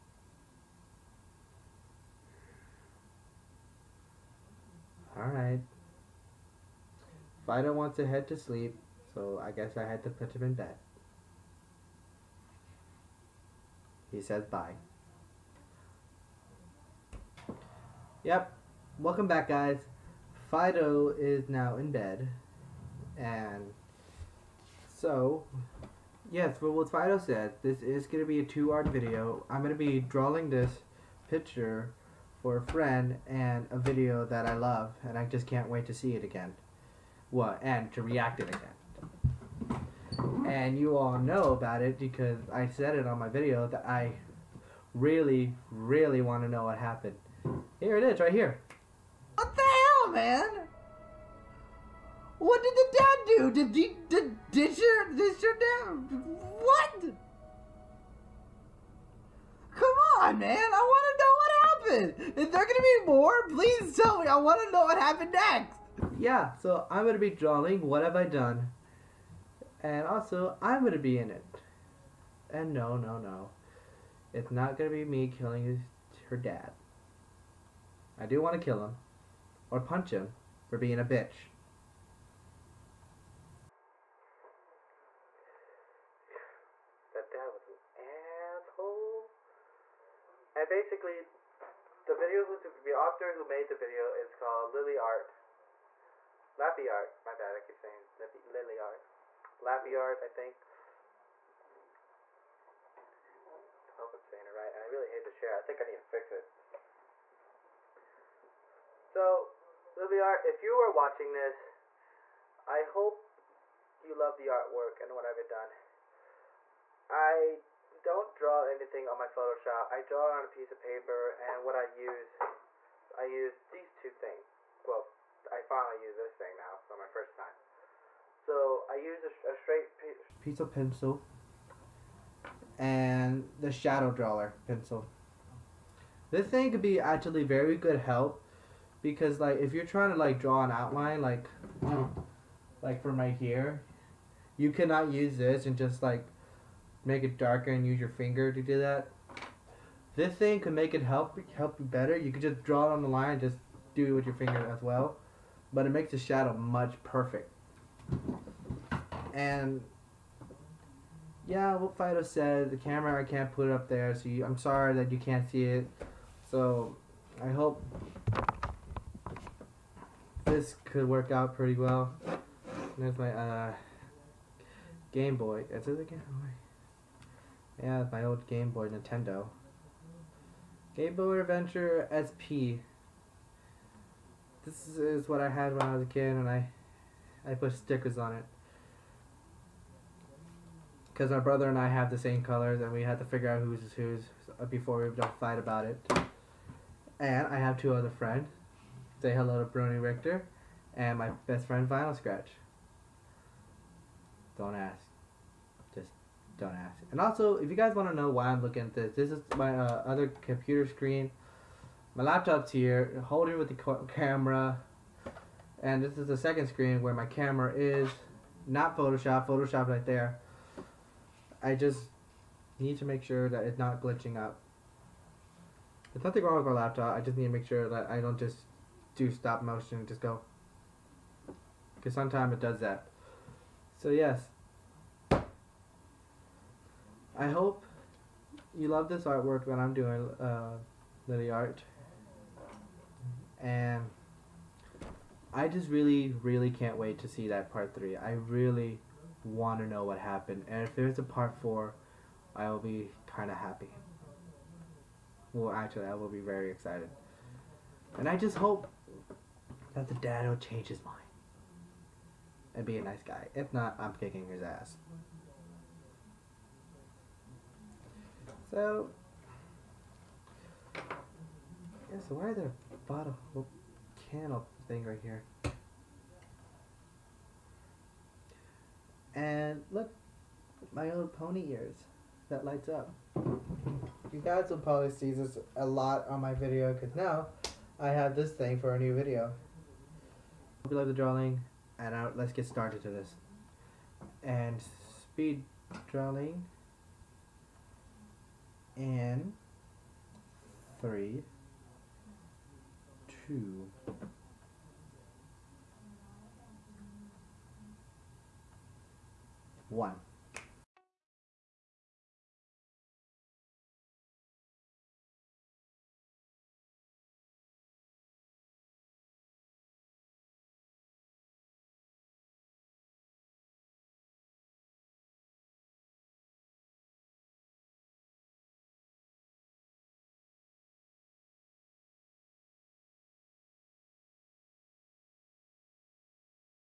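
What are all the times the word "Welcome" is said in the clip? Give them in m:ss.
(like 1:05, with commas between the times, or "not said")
0:18.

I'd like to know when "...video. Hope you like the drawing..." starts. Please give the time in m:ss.
4:49.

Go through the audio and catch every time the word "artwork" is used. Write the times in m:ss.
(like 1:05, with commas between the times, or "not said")
1:54, 3:59.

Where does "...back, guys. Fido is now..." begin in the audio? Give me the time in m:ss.
0:19.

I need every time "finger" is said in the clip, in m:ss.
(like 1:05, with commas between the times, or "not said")
2:28, 2:34.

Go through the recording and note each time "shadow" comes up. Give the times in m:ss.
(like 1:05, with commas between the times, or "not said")
2:13, 2:36.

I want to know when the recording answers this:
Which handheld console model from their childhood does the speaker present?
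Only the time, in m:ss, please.
3:00.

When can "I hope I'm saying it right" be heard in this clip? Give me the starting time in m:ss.
1:43.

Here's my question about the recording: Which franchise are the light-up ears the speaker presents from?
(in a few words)
My Little Pony.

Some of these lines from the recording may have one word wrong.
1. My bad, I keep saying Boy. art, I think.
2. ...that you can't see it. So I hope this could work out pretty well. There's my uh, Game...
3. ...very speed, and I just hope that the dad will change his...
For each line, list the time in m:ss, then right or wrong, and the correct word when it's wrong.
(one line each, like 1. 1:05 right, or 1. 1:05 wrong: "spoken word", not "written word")
1. 1:37 wrong: "Lilliard", not "Boy"
2. 2:44 right
3. 4:16 wrong: "excited", not "speed".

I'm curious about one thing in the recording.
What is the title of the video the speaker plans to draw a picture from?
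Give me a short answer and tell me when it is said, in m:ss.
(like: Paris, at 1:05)
What Have I Done?, at 1:07.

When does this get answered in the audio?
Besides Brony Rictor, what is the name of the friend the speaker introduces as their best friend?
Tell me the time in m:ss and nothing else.
3:21.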